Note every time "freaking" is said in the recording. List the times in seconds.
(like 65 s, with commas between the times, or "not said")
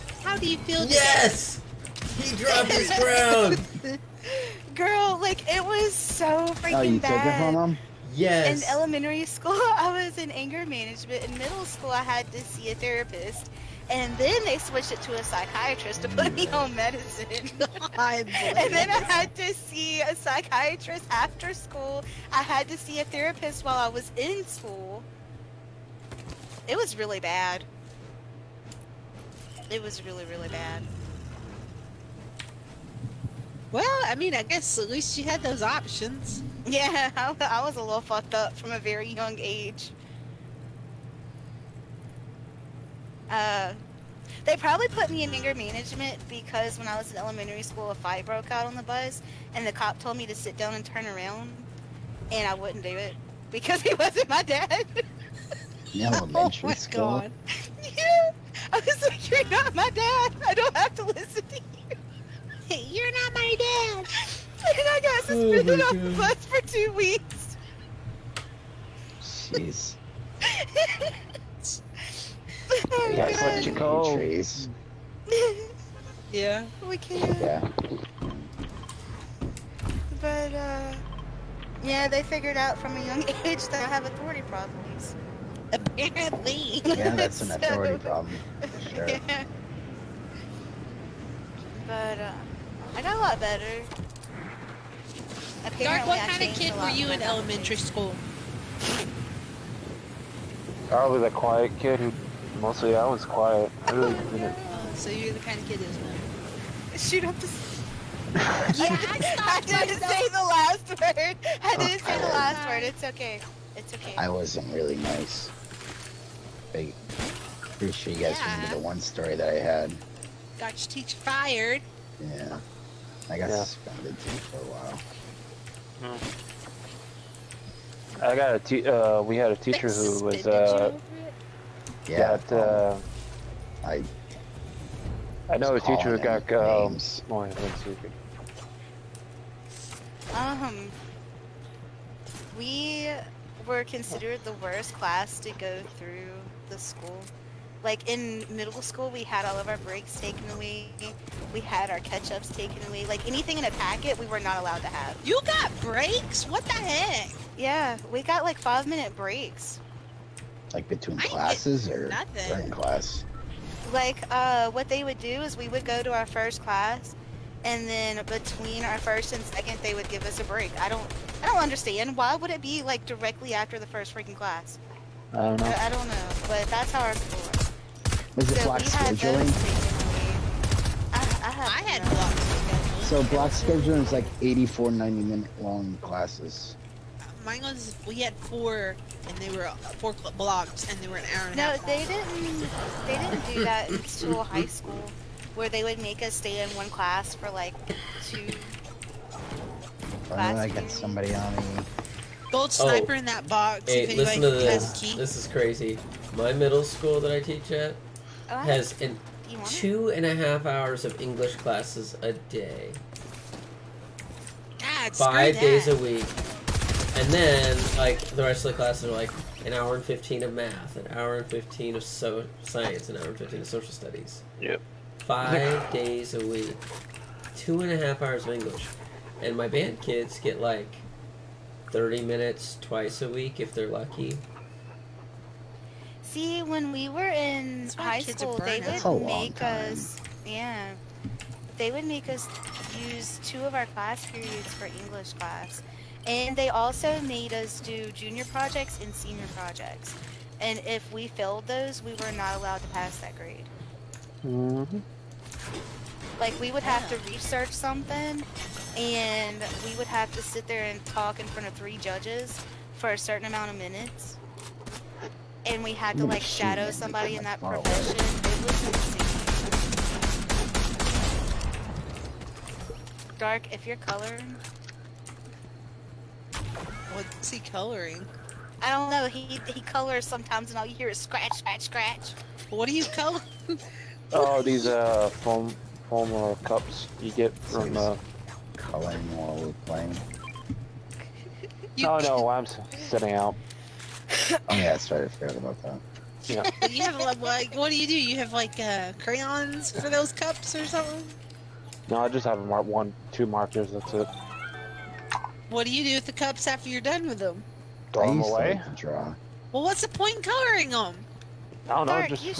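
6 s, 174 s.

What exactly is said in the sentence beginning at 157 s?
Yeah, we got like five minute breaks.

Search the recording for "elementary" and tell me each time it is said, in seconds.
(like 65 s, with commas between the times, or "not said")
8 s, 47 s, 56 s, 97 s.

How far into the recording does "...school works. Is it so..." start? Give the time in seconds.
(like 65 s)
177 s.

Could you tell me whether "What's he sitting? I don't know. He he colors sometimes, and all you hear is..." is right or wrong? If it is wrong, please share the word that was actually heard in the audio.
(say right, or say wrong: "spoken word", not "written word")
wrong: "coloring", not "sitting".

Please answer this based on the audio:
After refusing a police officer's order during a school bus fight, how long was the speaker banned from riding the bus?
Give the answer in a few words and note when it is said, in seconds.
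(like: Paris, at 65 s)
2 weeks, at 66 s.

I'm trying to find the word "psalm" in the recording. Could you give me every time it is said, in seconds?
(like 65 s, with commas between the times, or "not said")
not said.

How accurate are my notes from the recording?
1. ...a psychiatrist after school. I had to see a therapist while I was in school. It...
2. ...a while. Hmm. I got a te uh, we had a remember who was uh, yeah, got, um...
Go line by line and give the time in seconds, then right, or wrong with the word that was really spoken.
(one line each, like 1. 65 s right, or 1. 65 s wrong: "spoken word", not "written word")
1. 20 s right
2. 124 s wrong: "teacher", not "remember".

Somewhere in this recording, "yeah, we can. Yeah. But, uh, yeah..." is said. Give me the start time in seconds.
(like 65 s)
76 s.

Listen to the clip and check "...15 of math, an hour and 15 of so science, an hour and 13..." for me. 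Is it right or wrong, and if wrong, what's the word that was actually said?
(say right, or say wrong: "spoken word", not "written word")
wrong: "15", not "13".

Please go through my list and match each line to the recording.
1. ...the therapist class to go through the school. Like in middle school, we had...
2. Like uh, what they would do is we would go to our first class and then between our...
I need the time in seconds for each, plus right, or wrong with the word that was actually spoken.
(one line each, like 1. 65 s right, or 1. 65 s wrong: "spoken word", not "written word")
1. 144 s wrong: "worst", not "therapist"
2. 163 s right.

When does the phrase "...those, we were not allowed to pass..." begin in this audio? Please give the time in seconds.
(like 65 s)
251 s.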